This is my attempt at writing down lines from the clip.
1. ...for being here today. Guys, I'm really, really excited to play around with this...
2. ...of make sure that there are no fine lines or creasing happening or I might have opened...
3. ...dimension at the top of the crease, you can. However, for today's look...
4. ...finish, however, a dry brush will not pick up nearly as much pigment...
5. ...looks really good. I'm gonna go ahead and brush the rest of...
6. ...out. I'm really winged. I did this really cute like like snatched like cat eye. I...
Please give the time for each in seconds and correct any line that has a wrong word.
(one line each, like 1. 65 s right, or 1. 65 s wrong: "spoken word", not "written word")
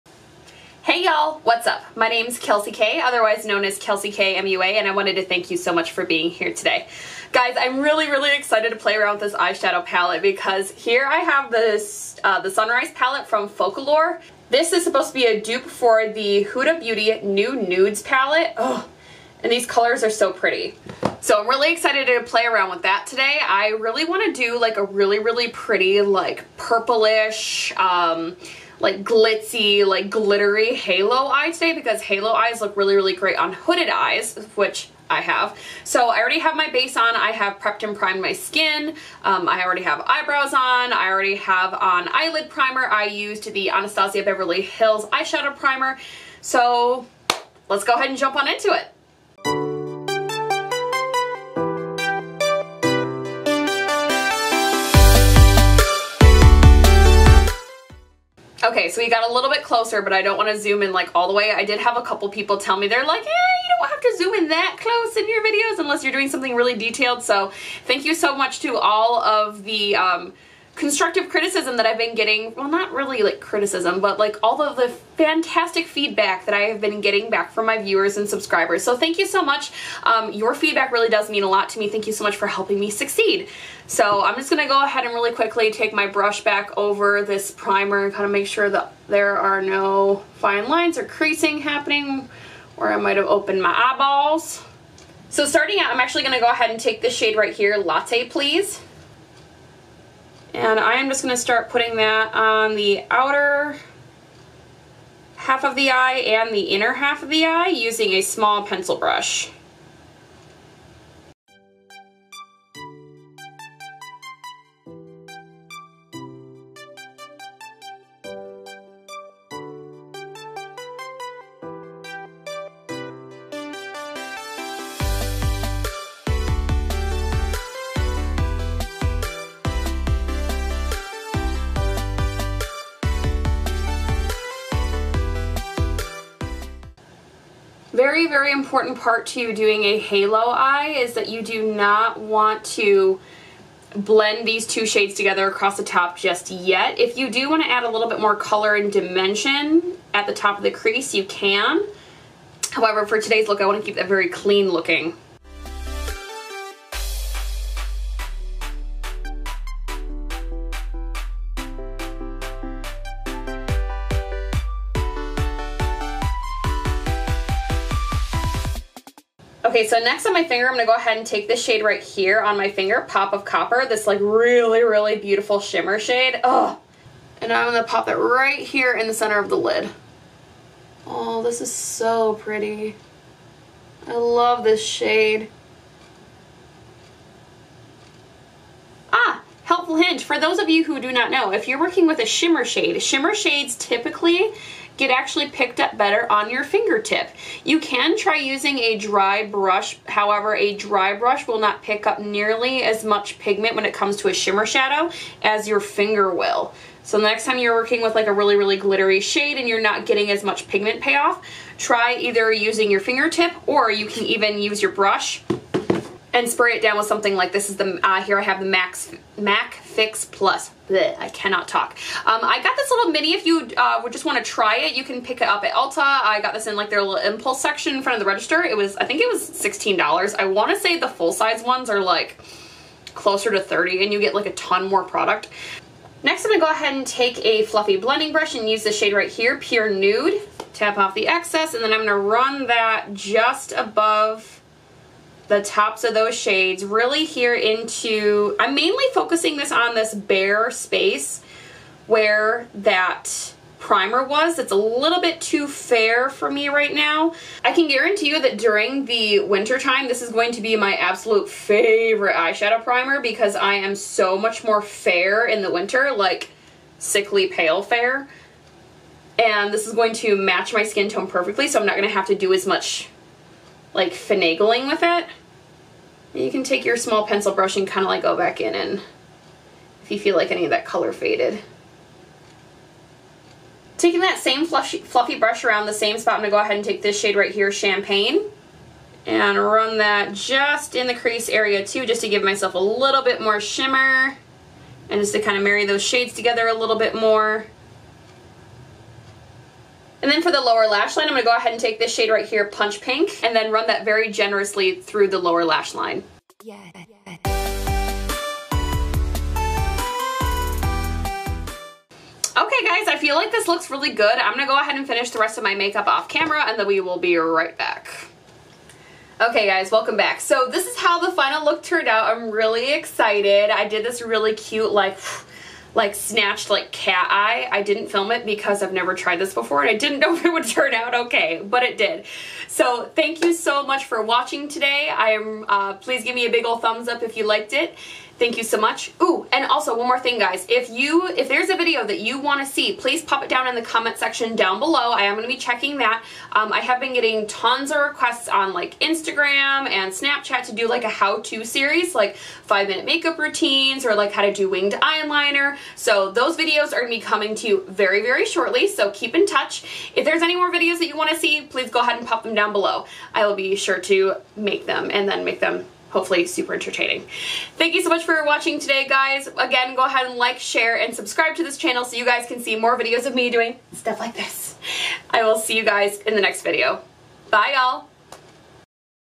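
1. 5 s right
2. 88 s right
3. 148 s right
4. 199 s wrong: "brush", not "finish"
5. 313 s wrong: "finish", not "brush"
6. 322 s wrong: "excited", not "winged".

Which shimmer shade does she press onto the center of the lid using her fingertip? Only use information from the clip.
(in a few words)
Pop of Copper.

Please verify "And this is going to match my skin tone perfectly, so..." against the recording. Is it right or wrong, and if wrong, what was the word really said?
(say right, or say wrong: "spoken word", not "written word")
right.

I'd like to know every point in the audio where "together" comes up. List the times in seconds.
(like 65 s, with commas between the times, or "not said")
145 s, 296 s.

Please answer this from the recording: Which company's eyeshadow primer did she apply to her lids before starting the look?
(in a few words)
Anastasia Beverly Hills.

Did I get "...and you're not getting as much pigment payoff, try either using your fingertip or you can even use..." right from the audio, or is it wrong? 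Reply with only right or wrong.
right.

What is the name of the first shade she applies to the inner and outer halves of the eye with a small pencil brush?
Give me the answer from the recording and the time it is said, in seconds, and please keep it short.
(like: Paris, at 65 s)
Latte Please, at 97 s.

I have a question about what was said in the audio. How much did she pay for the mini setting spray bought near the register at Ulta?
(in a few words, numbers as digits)
$16.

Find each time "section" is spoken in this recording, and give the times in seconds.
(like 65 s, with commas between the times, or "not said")
227 s, 344 s.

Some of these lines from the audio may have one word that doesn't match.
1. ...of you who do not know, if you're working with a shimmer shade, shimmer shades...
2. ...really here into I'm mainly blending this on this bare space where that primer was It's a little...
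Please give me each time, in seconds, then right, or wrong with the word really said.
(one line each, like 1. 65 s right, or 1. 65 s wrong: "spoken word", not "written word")
1. 190 s right
2. 246 s wrong: "focusing", not "blending".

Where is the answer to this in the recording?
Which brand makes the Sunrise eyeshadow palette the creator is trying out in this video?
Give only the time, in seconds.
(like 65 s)
13 s.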